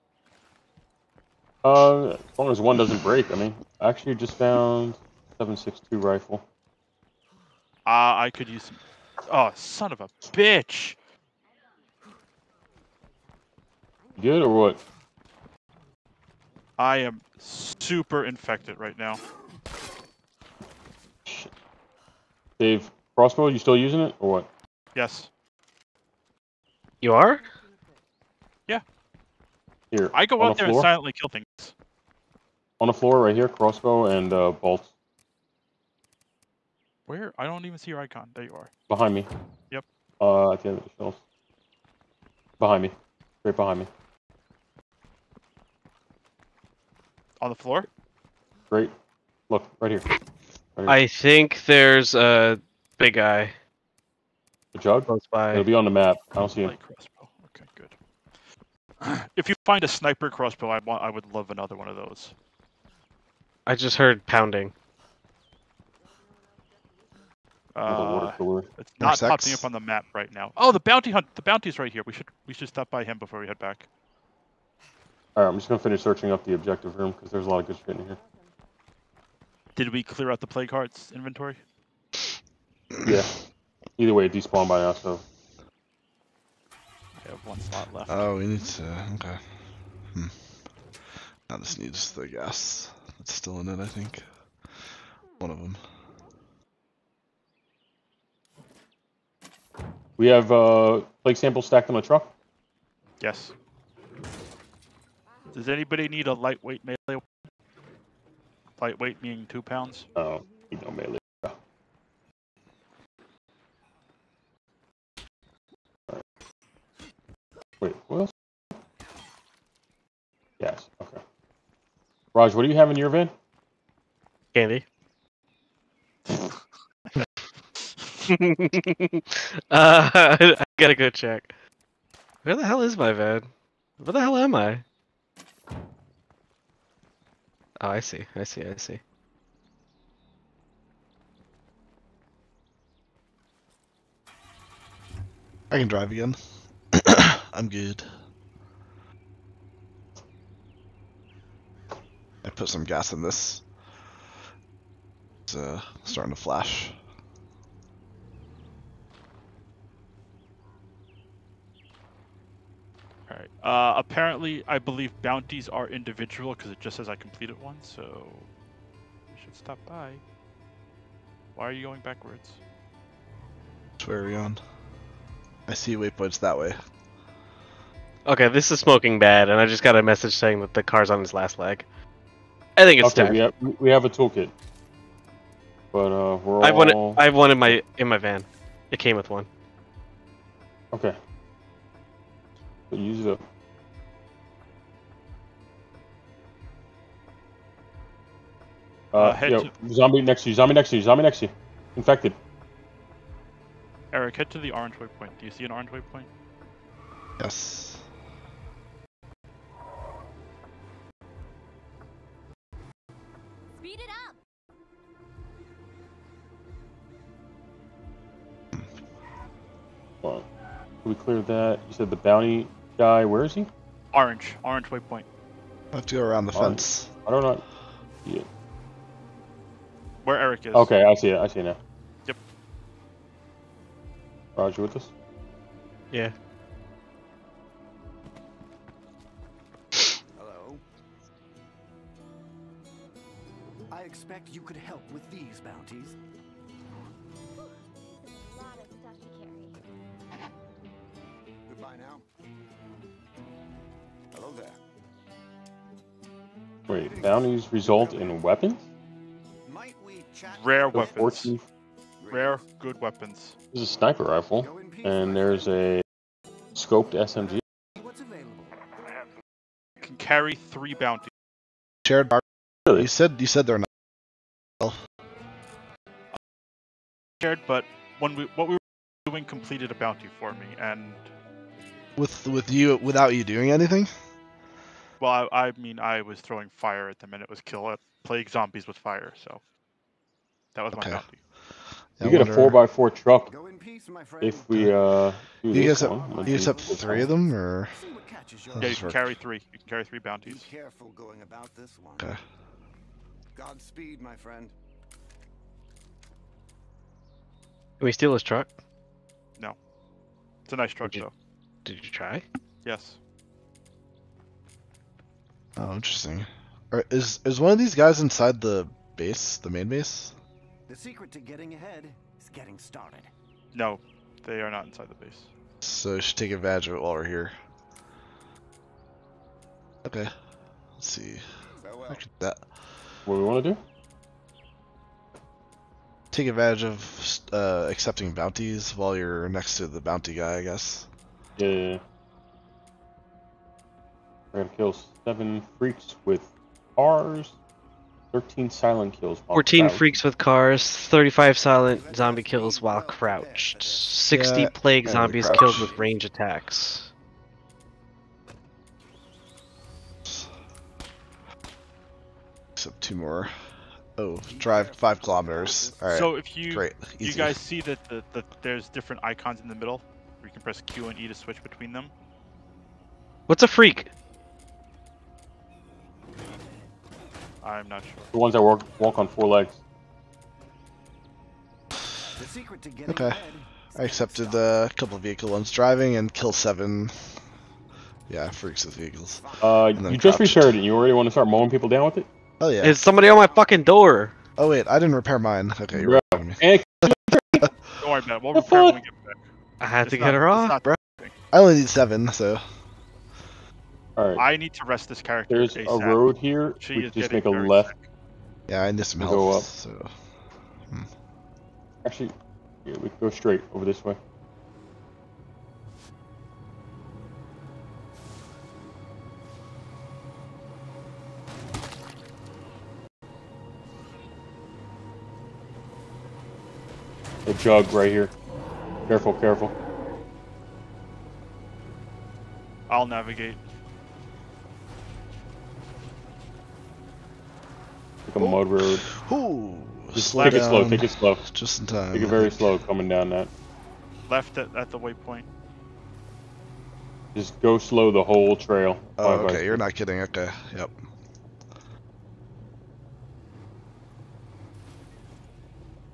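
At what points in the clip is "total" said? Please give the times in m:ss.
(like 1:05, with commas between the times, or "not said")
not said.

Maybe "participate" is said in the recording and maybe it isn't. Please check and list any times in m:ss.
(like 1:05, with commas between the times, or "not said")
not said.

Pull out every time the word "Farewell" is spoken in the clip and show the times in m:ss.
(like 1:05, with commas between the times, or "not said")
5:31.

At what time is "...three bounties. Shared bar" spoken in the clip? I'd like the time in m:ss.
4:30.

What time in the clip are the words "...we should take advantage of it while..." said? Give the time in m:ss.
5:26.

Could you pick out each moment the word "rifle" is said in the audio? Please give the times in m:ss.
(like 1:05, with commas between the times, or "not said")
0:06, 4:24.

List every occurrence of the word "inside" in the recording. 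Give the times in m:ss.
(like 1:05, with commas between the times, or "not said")
5:18, 5:24.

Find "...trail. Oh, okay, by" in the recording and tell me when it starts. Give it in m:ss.
7:28.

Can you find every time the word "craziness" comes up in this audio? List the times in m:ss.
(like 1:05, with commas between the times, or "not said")
not said.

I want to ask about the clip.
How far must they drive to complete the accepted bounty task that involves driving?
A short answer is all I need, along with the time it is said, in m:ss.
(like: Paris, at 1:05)
5 kilometers, at 6:04.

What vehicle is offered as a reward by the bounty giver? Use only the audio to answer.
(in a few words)
four by four truck.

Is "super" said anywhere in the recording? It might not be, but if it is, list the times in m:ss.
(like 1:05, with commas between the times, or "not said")
0:17.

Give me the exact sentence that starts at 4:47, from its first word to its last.
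Uh, plague zombies with fire, so.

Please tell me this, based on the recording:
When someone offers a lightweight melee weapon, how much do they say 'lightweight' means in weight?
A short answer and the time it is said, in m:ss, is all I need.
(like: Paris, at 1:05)
two pounds, at 1:49.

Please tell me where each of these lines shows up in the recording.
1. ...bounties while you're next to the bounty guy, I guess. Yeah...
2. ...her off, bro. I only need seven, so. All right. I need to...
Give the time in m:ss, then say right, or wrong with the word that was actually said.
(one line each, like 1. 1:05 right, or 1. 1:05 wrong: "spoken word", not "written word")
1. 5:38 right
2. 6:40 right.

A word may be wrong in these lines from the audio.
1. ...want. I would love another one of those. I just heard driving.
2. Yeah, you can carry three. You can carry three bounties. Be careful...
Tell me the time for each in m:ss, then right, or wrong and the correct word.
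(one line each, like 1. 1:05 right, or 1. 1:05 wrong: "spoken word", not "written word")
1. 1:00 wrong: "pounding", not "driving"
2. 4:58 right.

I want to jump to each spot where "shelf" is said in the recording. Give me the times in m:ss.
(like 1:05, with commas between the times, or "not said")
0:40.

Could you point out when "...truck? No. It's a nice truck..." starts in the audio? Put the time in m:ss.
5:08.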